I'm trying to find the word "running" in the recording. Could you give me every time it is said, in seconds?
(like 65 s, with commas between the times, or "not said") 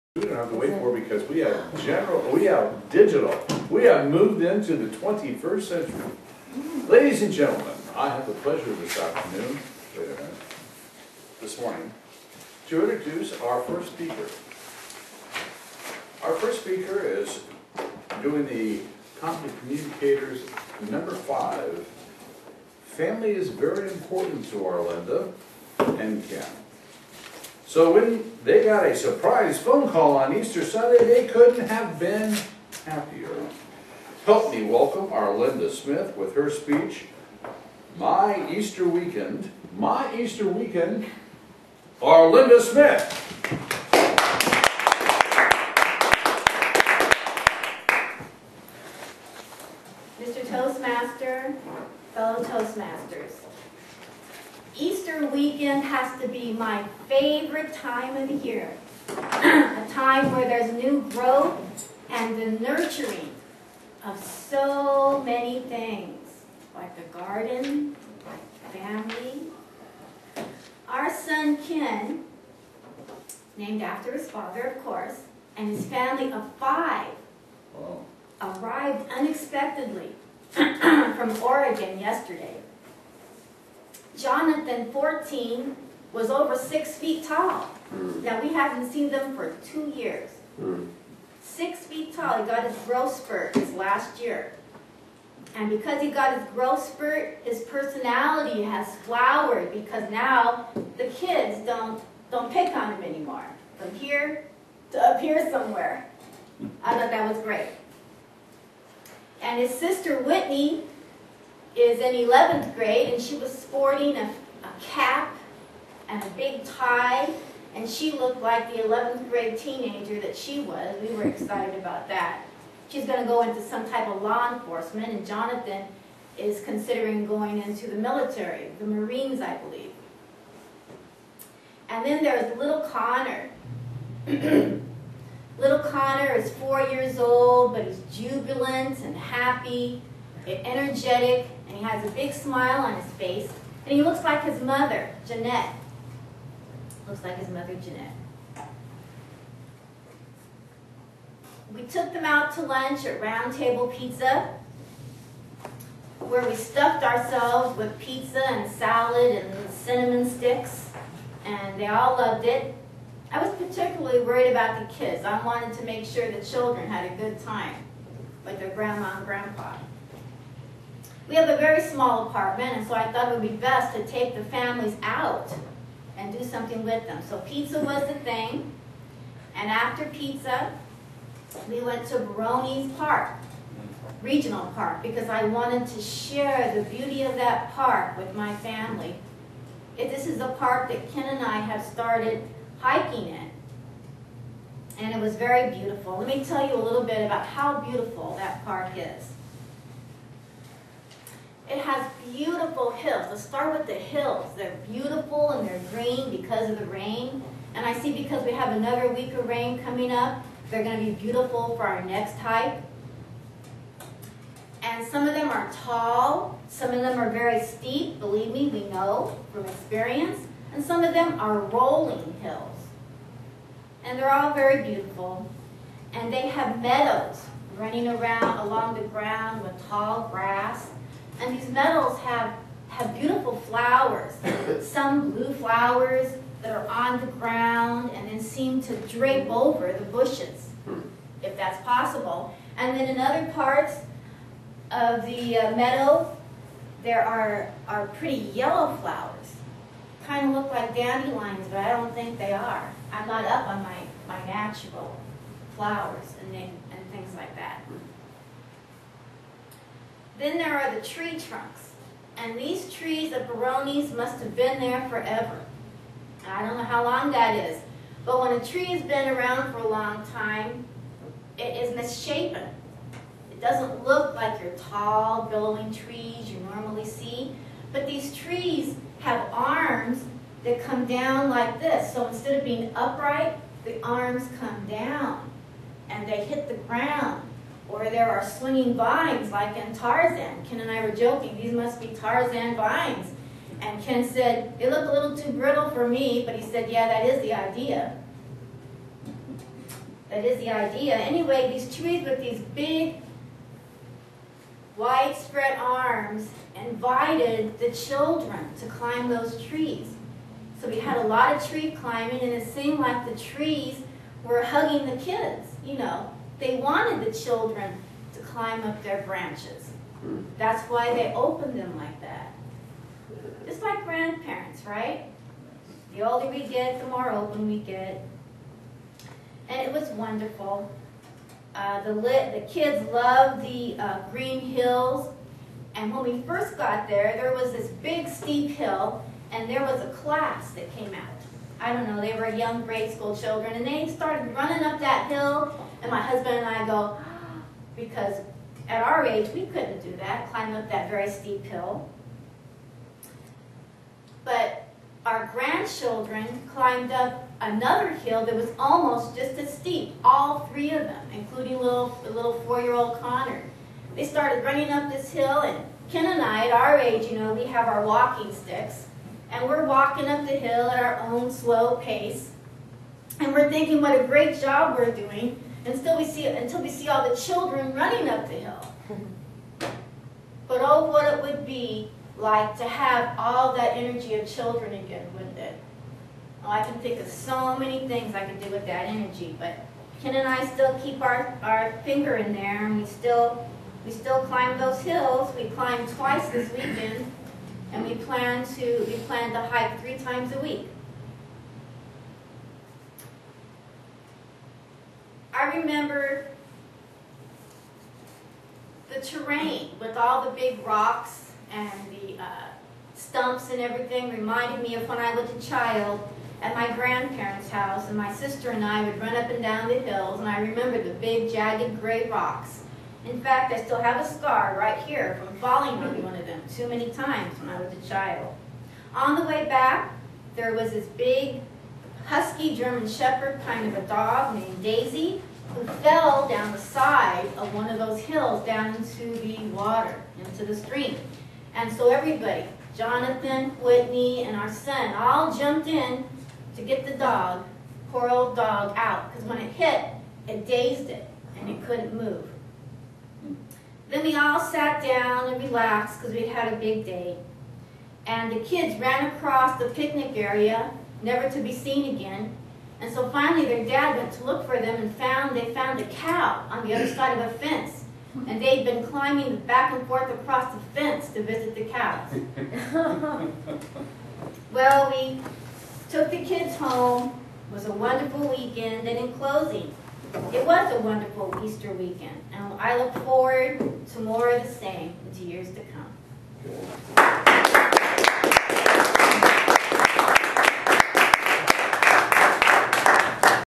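227 s, 344 s, 364 s, 377 s.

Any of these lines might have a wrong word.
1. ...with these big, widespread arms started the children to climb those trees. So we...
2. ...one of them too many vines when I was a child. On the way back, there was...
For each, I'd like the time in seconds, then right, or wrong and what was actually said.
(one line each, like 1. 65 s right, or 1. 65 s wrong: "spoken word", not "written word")
1. 302 s wrong: "invited", not "started"
2. 426 s wrong: "times", not "vines".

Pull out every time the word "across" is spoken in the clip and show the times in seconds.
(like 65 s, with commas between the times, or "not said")
459 s, 470 s.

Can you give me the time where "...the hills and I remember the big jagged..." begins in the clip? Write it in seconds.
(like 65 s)
419 s.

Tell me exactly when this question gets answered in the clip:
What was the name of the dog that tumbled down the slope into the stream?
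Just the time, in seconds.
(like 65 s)
434 s.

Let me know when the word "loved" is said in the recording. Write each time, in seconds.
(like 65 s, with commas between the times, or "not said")
162 s, 333 s.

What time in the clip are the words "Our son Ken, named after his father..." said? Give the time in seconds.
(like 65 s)
70 s.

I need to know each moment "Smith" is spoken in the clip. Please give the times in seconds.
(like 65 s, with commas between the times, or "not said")
35 s, 42 s.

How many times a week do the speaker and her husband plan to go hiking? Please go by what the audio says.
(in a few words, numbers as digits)
3.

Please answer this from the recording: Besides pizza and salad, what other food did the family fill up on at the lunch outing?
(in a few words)
Cinnamon sticks.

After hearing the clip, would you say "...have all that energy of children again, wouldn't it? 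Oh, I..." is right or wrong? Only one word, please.
right.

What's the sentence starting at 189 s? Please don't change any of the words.
This is a park that Ken and I have started hiking in, and it was very beautiful.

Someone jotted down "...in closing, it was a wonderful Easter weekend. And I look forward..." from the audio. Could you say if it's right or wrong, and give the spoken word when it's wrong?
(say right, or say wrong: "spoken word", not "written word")
right.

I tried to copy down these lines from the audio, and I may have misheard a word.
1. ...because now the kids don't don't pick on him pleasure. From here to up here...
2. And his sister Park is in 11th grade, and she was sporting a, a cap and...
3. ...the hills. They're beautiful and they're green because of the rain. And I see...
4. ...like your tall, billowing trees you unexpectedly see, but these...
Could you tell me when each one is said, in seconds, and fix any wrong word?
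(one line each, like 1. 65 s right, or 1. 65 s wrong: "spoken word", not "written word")
1. 99 s wrong: "anymore", not "pleasure"
2. 109 s wrong: "Whitney", not "Park"
3. 203 s right
4. 274 s wrong: "normally", not "unexpectedly".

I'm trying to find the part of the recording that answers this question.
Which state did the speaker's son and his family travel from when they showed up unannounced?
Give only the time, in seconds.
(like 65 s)
81 s.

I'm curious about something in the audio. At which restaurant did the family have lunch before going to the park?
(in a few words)
Round Table Pizza.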